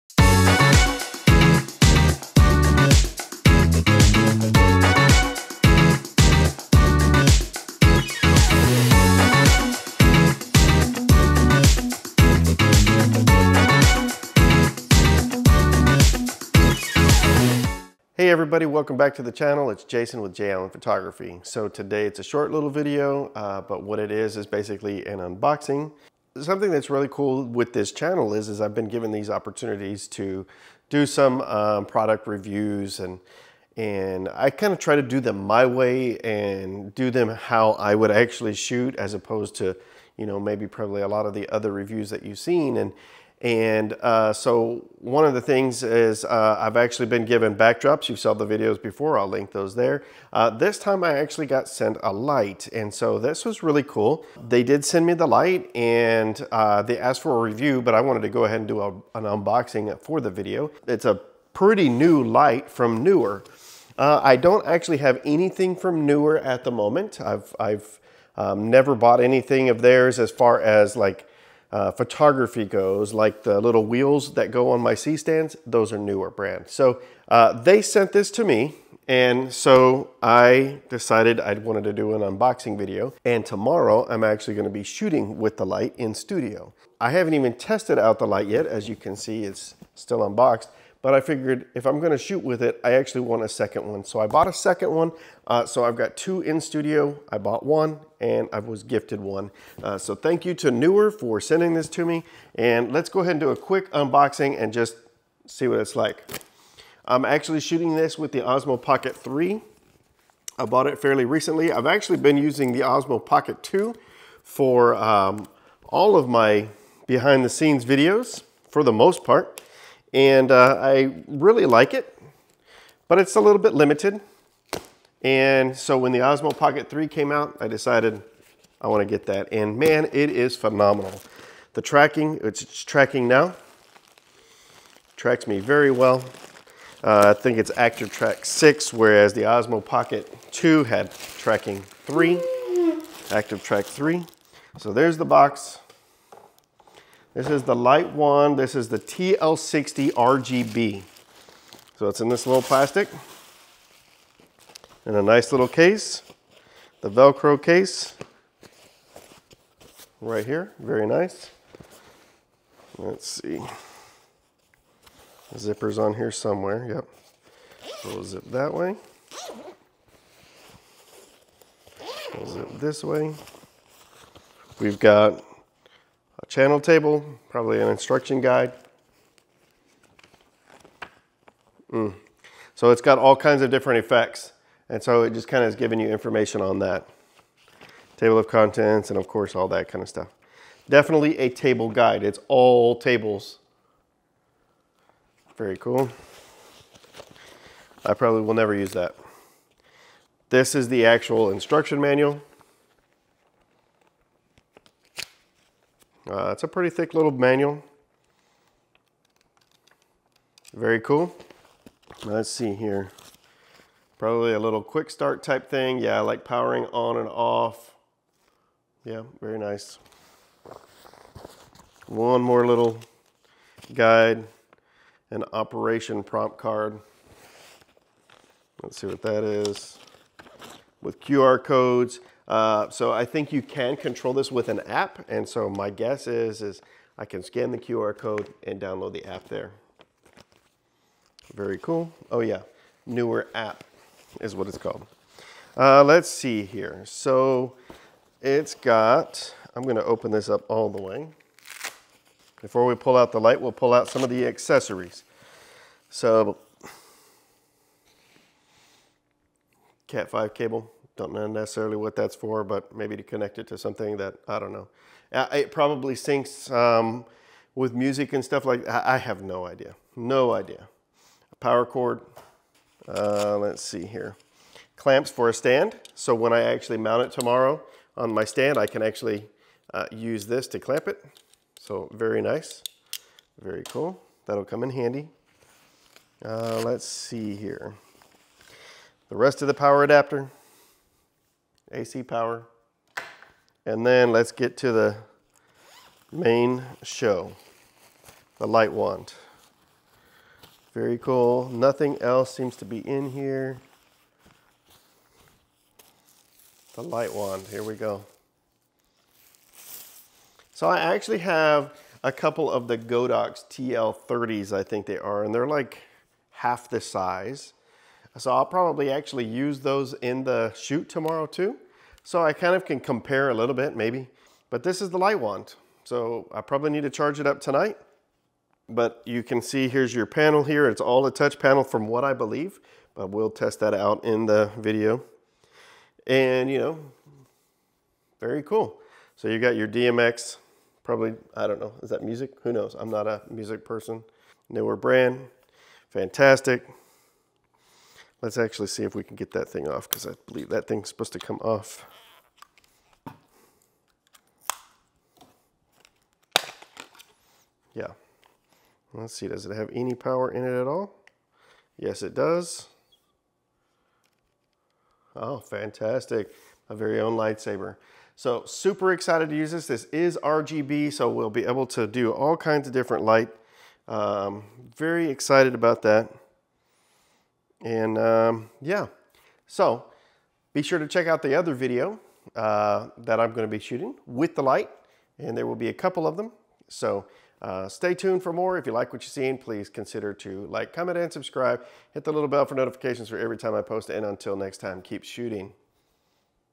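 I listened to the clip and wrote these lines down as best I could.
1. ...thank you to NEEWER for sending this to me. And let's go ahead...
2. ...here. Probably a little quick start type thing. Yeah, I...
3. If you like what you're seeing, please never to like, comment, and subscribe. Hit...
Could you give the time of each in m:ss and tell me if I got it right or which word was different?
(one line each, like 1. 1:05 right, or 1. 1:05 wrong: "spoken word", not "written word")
1. 1:40 right
2. 3:32 right
3. 6:28 wrong: "consider", not "never".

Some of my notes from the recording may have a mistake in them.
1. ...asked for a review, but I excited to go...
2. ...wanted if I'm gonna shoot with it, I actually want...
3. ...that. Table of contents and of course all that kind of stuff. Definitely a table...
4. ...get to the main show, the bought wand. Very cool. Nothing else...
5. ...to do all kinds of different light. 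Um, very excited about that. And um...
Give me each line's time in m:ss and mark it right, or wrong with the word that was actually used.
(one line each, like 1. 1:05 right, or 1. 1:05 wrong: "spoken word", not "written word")
1. 0:56 wrong: "wanted", not "excited"
2. 1:31 wrong: "figured", not "wanted"
3. 3:06 right
4. 4:54 wrong: "light", not "bought"
5. 6:11 right.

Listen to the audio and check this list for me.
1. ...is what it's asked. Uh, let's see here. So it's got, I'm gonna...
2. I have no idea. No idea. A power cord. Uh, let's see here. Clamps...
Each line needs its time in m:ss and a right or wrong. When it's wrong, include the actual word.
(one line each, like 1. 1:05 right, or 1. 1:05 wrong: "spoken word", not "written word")
1. 4:04 wrong: "called", not "asked"
2. 4:29 right.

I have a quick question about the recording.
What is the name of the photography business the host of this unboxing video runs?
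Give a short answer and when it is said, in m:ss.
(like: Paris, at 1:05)
J Allen Photography, at 0:20.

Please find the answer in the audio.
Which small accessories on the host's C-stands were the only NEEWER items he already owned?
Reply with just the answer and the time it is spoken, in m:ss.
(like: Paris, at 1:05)
The little wheels, at 1:13.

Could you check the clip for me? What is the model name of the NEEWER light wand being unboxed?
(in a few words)
TL60 RGB.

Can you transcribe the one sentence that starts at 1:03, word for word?
Uh, I don't actually have anything from NEEWER at the moment.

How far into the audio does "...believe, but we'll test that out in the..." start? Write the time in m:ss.
5:32.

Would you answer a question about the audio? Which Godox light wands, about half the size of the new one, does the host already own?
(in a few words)
Godox TL30s.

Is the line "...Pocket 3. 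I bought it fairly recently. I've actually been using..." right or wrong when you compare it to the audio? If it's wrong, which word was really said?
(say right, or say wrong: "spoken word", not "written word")
right.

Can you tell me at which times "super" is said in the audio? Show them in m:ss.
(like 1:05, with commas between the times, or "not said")
6:08.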